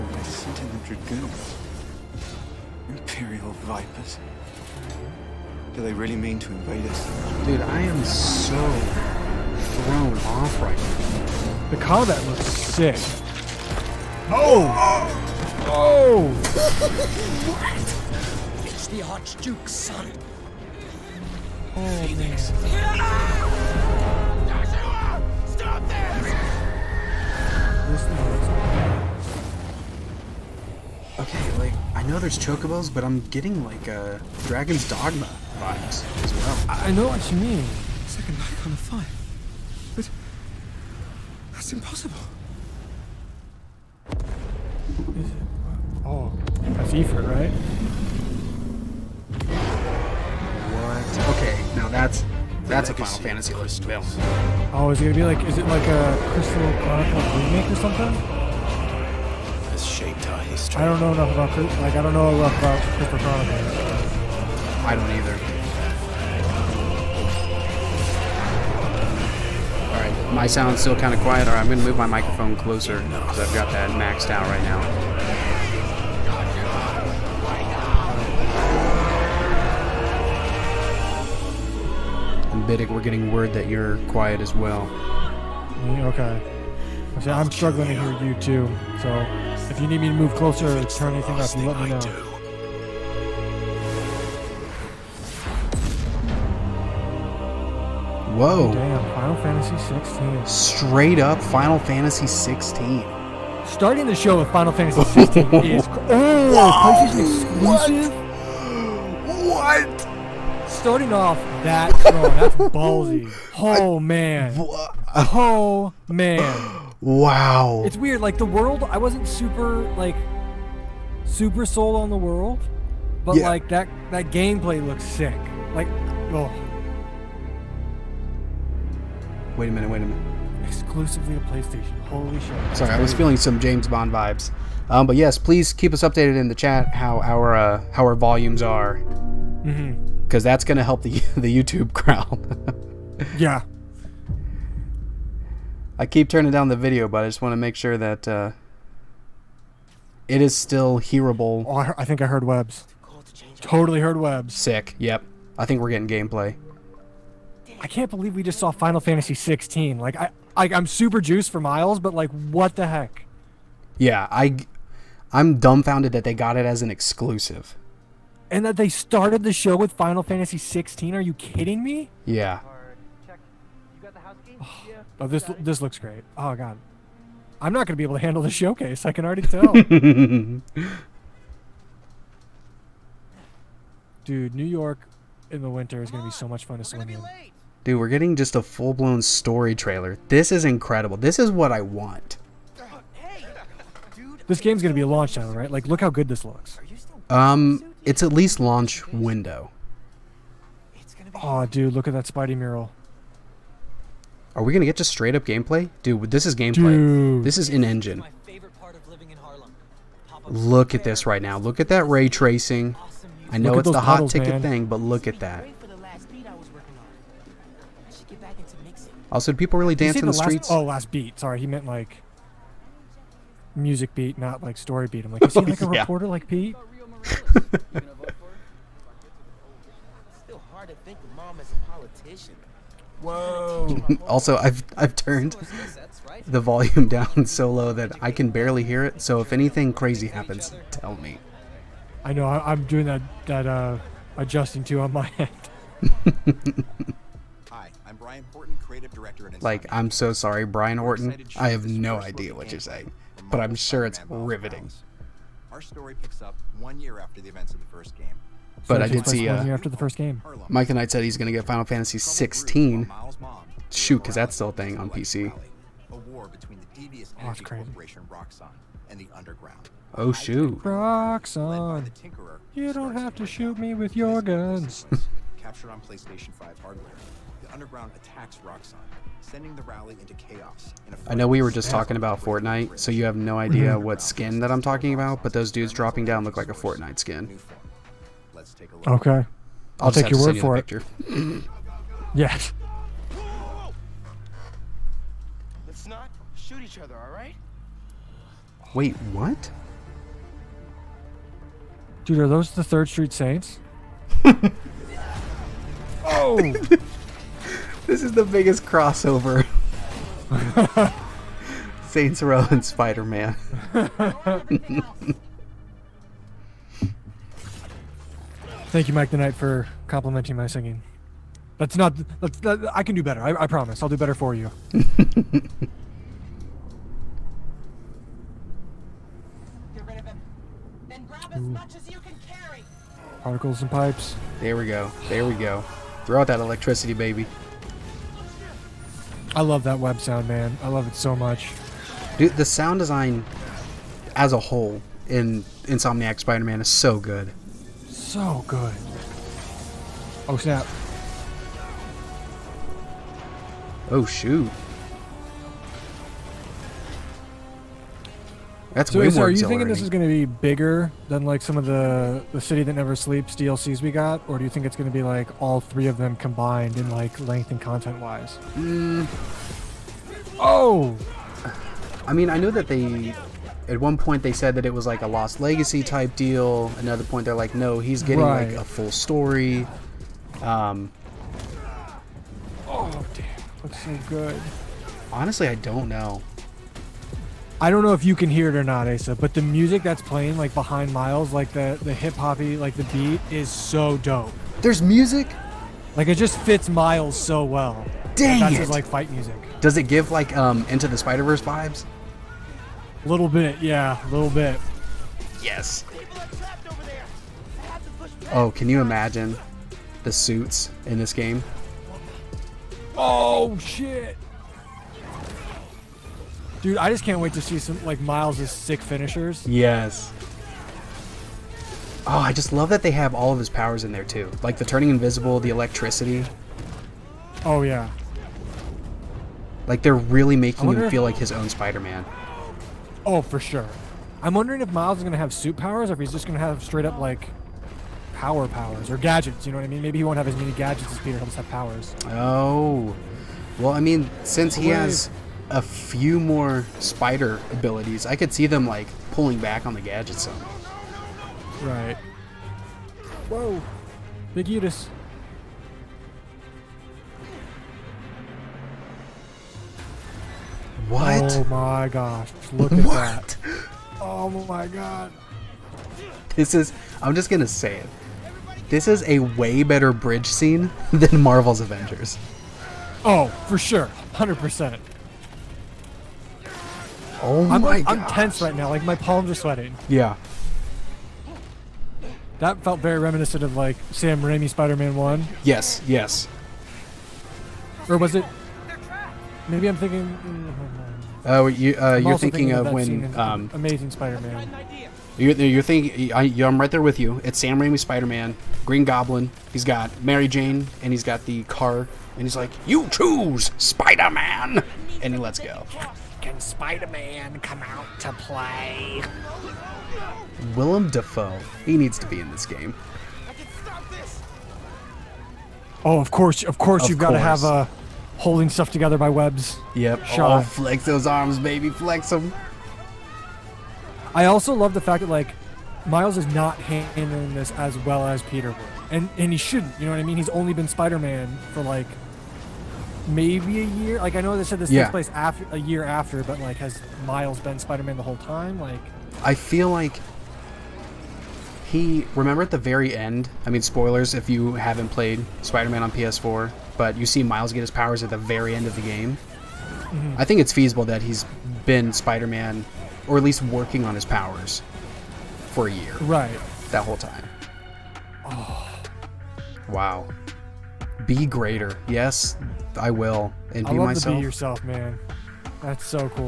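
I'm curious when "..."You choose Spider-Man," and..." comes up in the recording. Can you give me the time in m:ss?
8:22.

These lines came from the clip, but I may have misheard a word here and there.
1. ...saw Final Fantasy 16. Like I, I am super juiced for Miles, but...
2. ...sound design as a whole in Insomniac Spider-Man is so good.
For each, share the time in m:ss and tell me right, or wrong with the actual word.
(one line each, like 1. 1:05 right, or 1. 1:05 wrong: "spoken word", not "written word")
1. 2:38 right
2. 5:42 right.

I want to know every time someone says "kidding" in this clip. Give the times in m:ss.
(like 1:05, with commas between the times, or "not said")
2:51.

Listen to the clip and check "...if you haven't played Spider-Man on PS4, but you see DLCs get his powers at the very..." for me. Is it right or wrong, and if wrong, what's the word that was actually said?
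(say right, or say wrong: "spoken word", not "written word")
wrong: "Miles", not "DLCs".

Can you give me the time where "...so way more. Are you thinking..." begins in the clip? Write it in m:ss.
5:59.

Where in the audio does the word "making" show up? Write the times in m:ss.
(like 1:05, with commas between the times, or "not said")
7:10.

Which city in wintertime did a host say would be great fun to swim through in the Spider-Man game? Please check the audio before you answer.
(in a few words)
New York.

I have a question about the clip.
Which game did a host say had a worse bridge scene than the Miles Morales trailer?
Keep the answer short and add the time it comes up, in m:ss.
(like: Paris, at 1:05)
Marvel's Avengers, at 7:51.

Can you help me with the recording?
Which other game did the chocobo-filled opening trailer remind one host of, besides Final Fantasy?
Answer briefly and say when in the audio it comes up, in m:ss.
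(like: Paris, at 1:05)
Dragon's Dogma, at 0:34.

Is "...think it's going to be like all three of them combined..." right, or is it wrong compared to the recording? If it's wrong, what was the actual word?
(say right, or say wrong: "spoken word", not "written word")
right.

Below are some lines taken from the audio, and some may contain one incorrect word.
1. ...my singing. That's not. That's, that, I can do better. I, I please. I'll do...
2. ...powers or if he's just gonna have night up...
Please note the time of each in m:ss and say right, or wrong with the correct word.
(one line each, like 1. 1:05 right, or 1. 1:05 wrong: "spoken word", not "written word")
1. 5:20 wrong: "promise", not "please"
2. 7:15 wrong: "straight", not "night".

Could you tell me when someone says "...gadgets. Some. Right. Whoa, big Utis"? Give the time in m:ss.
7:29.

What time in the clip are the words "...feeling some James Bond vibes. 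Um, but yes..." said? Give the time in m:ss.
2:13.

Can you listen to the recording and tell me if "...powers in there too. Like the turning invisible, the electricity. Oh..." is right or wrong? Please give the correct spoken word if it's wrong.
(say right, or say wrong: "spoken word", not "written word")
right.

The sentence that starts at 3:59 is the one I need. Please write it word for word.
So if anything crazy happens, tell me.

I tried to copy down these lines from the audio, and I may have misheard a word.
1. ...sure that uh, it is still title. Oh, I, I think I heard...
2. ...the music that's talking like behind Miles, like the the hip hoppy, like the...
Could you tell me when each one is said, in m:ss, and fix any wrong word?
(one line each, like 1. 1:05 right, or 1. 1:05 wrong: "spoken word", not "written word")
1. 2:27 wrong: "hearable", not "title"
2. 6:29 wrong: "playing", not "talking".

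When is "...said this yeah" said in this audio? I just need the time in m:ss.
8:54.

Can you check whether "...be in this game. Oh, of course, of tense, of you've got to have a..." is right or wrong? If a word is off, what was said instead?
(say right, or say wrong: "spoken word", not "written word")
wrong: "course", not "tense".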